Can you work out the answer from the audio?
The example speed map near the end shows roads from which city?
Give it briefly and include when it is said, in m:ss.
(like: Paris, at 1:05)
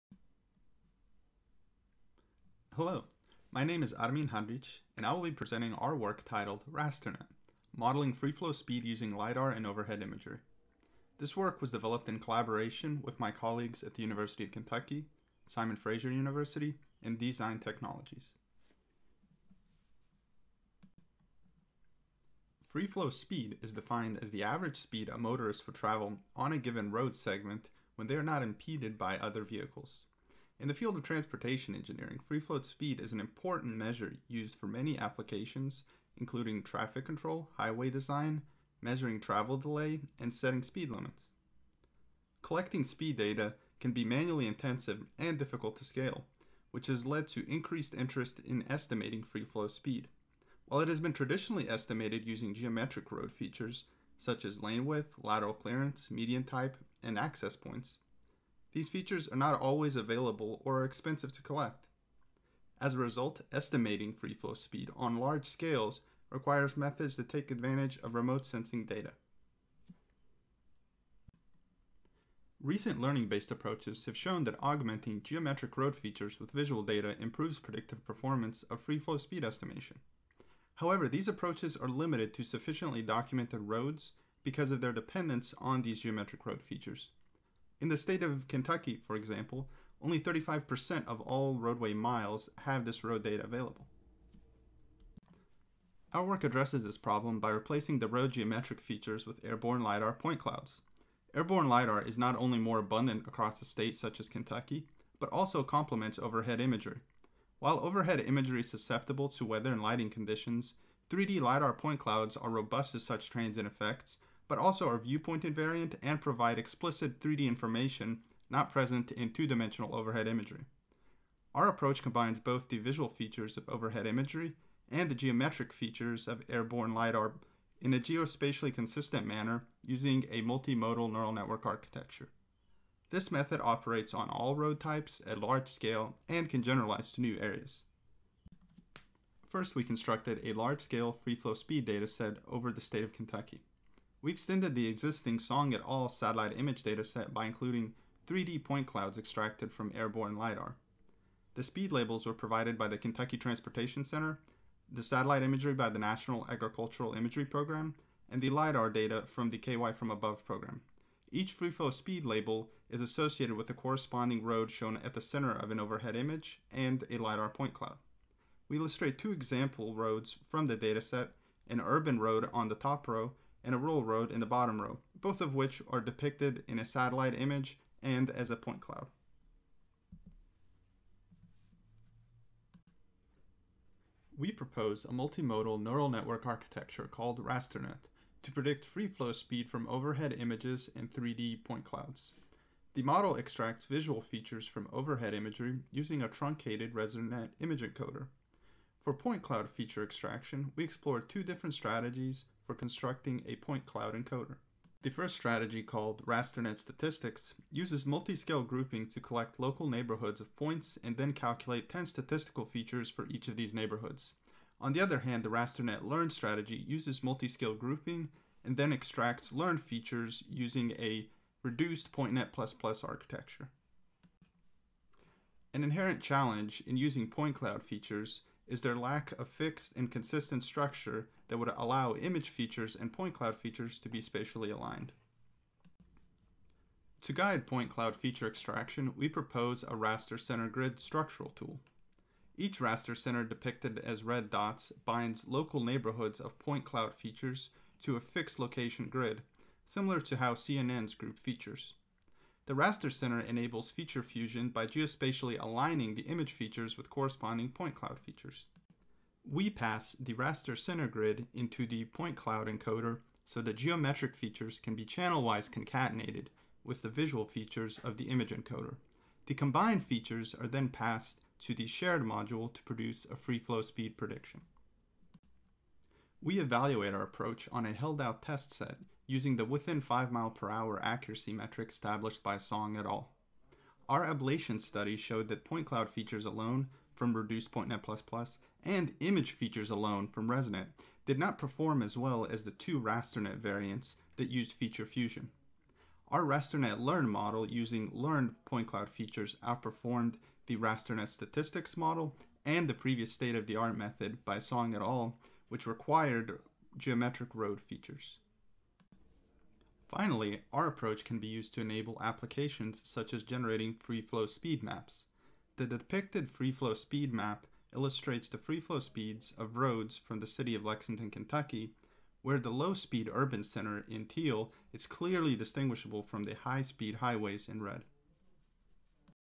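Lexington, Kentucky, at 5:20.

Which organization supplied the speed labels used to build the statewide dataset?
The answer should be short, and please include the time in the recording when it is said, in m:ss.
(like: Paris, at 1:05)
Kentucky Transportation Center, at 2:32.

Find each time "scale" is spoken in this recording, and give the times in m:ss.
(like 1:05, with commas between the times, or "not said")
0:45, 1:05, 2:15, 2:20, 3:28, 3:37.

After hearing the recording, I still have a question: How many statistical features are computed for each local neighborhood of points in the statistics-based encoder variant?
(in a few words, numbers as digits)
10.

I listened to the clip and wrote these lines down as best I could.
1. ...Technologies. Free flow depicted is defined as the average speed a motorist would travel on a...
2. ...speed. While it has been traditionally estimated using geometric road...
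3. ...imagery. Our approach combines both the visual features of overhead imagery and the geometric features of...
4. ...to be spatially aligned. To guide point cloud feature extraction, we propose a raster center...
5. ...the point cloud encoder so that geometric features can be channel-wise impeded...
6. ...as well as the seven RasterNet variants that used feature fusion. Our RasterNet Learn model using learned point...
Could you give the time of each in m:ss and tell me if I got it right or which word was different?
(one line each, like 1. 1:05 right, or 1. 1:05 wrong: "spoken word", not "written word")
1. 0:17 wrong: "speed", not "depicted"
2. 0:49 right
3. 2:00 right
4. 3:53 right
5. 4:21 wrong: "concatenated", not "impeded"
6. 4:52 wrong: "two", not "seven".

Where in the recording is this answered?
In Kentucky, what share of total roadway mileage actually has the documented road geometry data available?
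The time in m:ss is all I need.
1:30.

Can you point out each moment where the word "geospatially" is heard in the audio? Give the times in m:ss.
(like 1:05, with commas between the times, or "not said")
2:07, 4:14.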